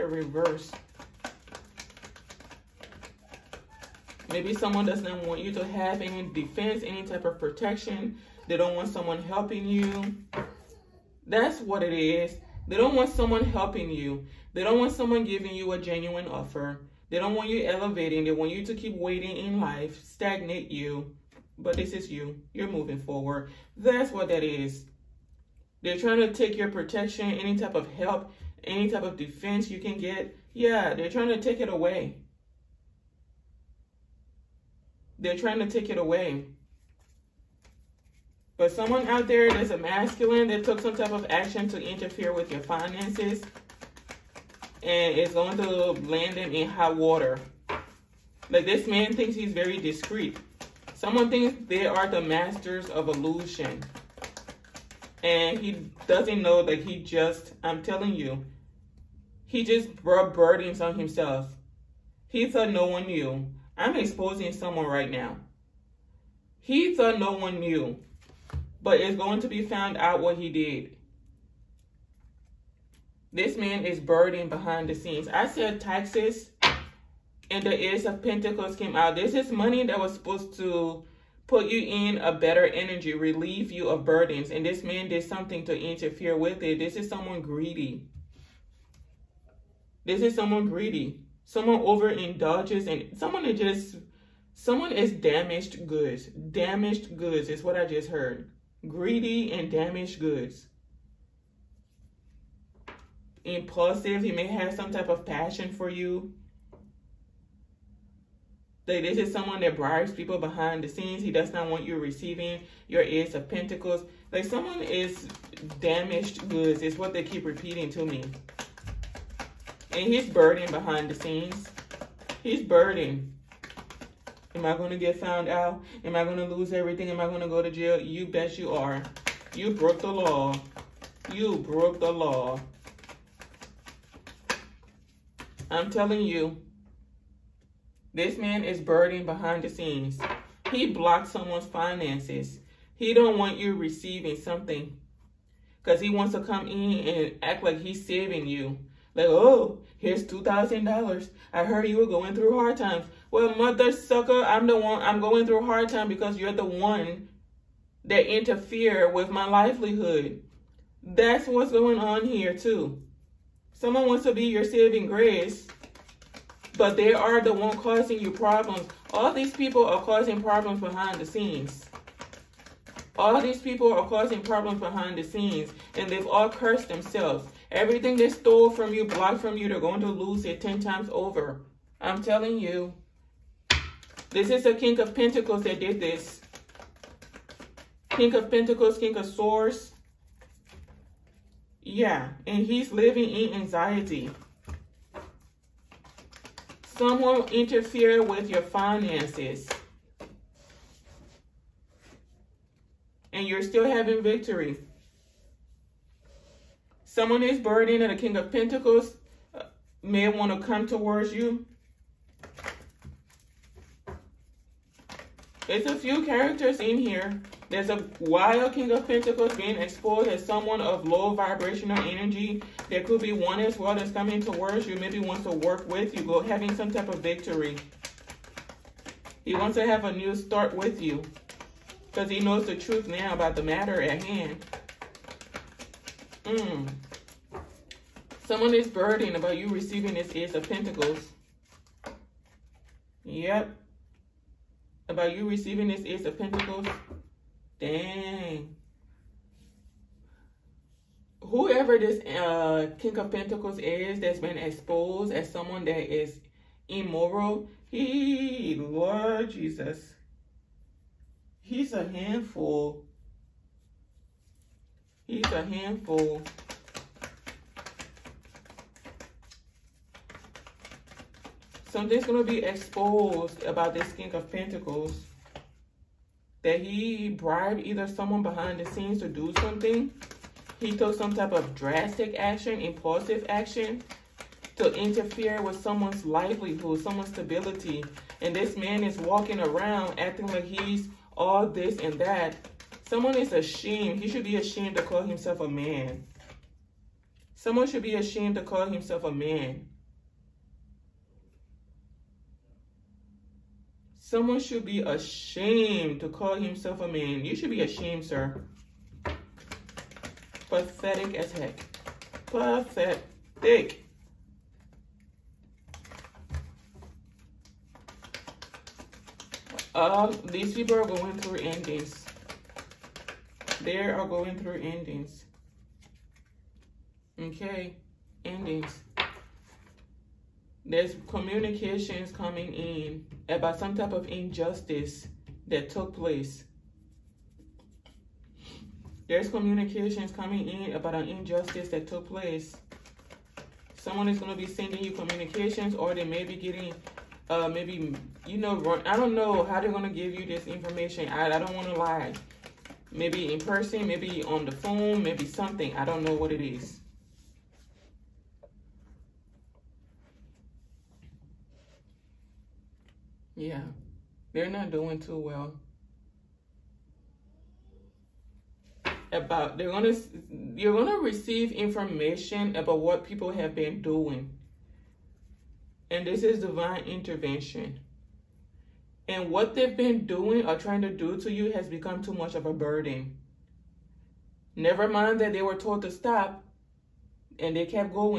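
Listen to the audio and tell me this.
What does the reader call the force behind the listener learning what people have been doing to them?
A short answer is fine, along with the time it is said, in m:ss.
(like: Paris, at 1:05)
divine intervention, at 6:16.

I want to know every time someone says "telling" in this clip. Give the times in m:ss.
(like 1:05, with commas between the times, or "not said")
0:57, 2:15, 3:02.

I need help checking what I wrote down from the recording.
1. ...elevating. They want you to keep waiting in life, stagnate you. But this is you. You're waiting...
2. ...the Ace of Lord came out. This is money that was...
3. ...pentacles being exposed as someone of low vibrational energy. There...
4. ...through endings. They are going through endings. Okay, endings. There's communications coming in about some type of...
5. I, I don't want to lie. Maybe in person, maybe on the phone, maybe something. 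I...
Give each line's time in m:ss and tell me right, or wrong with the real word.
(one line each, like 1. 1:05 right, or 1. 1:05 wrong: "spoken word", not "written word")
1. 0:17 wrong: "moving", not "waiting"
2. 1:17 wrong: "Pentacles", not "Lord"
3. 3:39 right
4. 5:21 right
5. 5:51 right.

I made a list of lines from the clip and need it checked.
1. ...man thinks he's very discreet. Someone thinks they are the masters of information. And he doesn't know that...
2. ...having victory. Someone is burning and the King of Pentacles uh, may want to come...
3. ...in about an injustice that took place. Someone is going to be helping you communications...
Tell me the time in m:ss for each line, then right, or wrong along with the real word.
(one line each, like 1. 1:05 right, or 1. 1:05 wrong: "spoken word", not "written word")
1. 0:48 wrong: "illusion", not "information"
2. 3:23 right
3. 5:40 wrong: "sending", not "helping".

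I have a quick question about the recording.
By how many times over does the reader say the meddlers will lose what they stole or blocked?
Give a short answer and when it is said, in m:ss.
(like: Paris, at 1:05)
10, at 3:00.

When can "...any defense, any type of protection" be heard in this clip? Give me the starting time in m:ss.
0:06.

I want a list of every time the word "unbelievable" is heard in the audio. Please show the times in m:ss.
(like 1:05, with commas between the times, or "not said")
not said.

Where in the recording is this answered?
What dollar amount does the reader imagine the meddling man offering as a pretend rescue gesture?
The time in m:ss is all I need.
2:30.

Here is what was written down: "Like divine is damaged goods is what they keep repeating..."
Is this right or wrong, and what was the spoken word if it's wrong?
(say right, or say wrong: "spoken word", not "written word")
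wrong: "someone", not "divine".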